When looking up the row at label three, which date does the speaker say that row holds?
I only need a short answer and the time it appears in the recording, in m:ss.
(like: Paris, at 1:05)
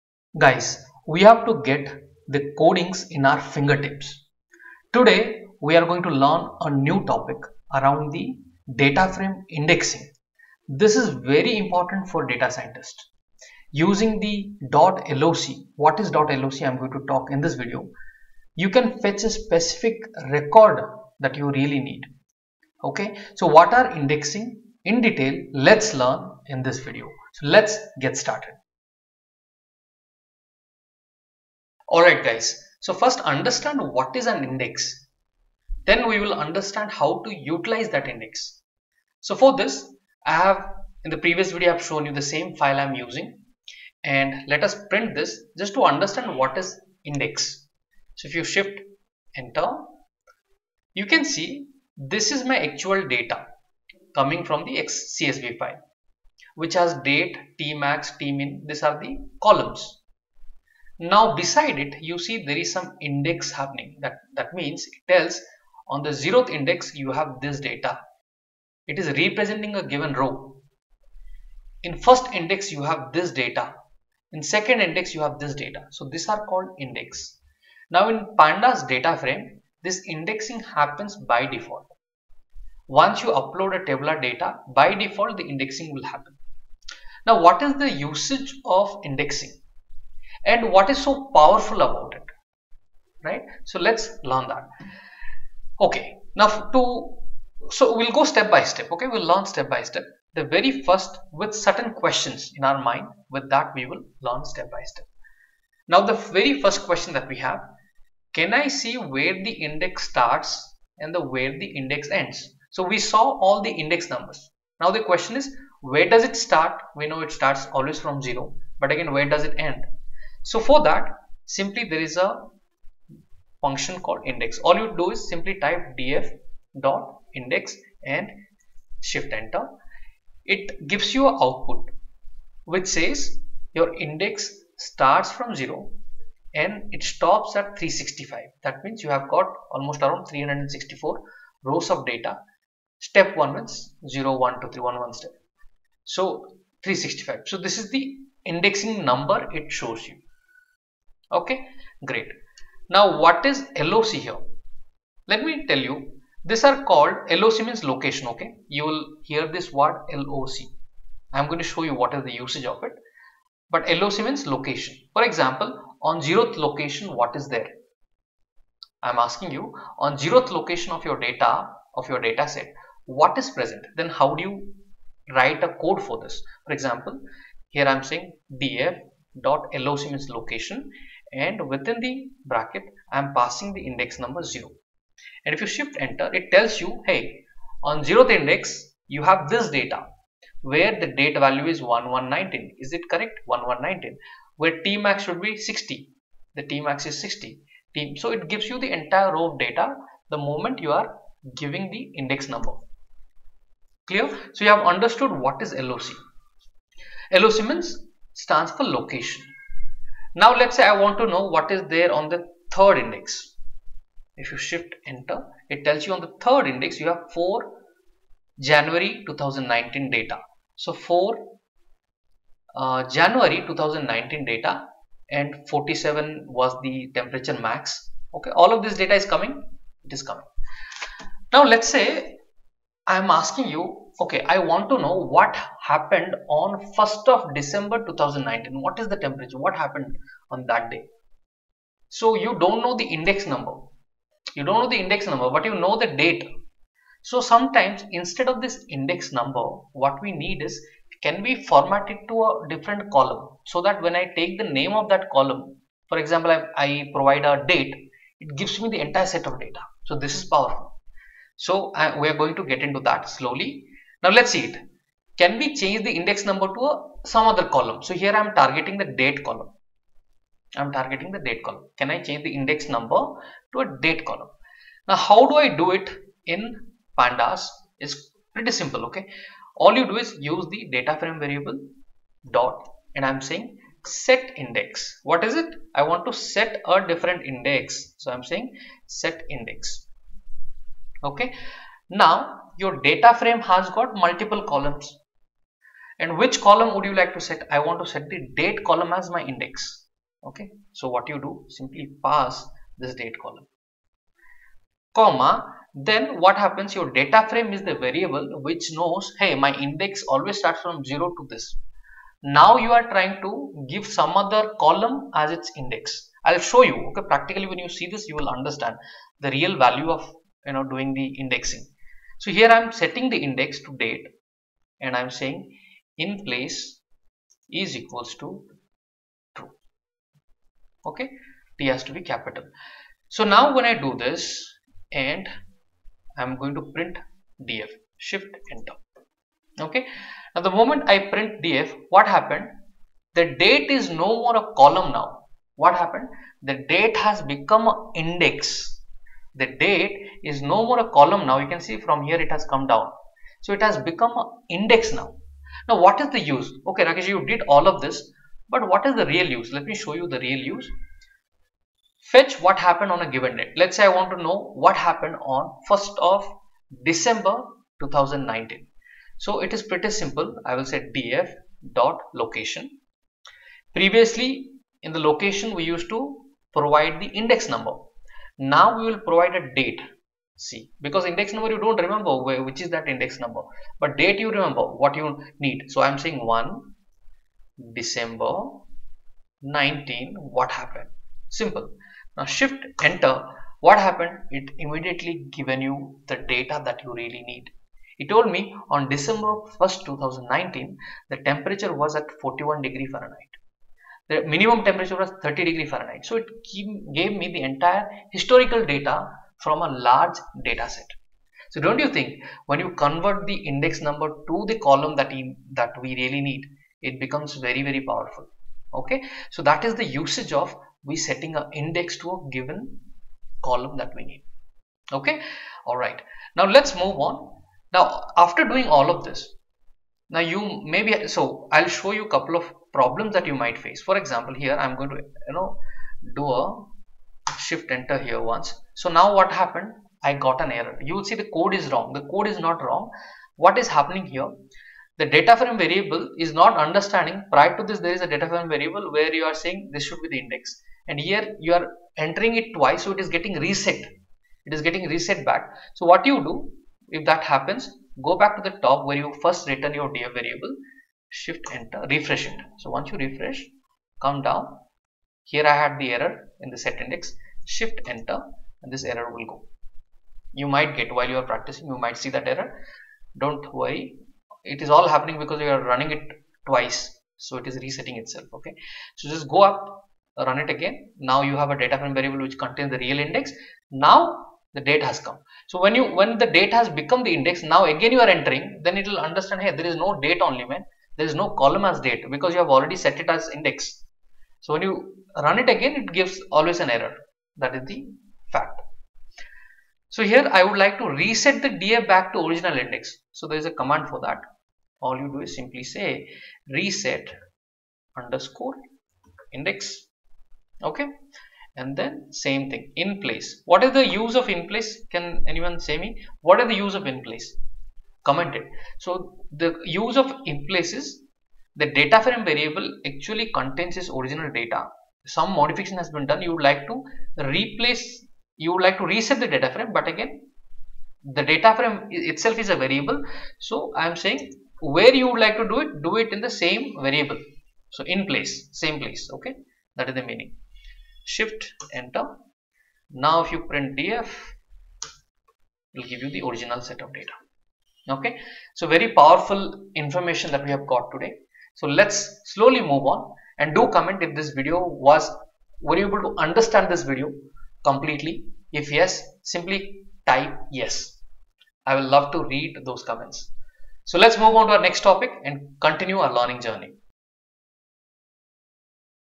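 4 January 2019, at 3:37.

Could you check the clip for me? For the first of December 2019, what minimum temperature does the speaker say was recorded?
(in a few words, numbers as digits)
30 degrees Fahrenheit.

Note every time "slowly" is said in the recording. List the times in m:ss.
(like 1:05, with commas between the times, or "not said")
4:23, 9:12.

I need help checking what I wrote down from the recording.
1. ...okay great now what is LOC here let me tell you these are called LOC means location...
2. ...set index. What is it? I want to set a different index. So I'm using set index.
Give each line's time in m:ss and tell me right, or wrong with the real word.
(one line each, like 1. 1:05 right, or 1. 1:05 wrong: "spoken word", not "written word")
1. 2:31 right
2. 4:44 wrong: "saying", not "using".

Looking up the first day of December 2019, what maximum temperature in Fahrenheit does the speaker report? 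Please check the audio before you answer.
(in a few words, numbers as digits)
41.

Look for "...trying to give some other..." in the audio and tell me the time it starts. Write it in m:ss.
5:13.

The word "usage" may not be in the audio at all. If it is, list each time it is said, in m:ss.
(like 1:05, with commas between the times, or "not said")
1:27, 2:42, 7:00.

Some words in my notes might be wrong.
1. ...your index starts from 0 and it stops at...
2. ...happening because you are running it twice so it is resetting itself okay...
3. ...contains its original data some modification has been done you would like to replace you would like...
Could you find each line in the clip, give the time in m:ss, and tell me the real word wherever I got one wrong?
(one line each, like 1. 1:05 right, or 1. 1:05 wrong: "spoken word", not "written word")
1. 2:13 right
2. 7:55 right
3. 8:43 right.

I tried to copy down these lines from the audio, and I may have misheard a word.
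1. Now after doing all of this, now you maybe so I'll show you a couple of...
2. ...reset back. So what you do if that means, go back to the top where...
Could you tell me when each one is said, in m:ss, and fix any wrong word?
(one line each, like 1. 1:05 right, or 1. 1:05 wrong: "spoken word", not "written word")
1. 7:07 right
2. 7:35 wrong: "happens", not "means".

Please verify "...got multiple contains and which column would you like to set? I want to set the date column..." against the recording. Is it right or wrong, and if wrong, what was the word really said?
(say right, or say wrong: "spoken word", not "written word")
wrong: "columns", not "contains".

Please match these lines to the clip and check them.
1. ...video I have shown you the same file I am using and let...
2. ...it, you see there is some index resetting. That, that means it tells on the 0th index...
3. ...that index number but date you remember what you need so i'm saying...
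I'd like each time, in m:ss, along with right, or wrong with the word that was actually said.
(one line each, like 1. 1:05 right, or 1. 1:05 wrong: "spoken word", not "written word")
1. 0:41 right
2. 1:01 wrong: "happening", not "resetting"
3. 6:22 right.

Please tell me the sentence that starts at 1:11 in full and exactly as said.
In first index, you have this data.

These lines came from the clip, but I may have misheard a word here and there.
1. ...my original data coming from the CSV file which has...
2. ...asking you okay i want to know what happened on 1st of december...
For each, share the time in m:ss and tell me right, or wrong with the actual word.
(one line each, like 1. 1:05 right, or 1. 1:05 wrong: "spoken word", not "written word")
1. 0:52 wrong: "actual", not "original"
2. 3:53 right.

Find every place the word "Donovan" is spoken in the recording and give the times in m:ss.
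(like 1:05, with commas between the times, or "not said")
not said.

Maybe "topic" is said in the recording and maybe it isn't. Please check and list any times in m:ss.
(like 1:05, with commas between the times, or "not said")
0:07, 9:25.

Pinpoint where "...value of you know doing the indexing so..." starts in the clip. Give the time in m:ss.
5:19.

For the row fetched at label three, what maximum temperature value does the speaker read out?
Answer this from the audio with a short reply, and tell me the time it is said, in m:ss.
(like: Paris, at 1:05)
47, at 3:45.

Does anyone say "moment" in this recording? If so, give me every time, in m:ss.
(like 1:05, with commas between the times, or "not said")
3:20, 5:40.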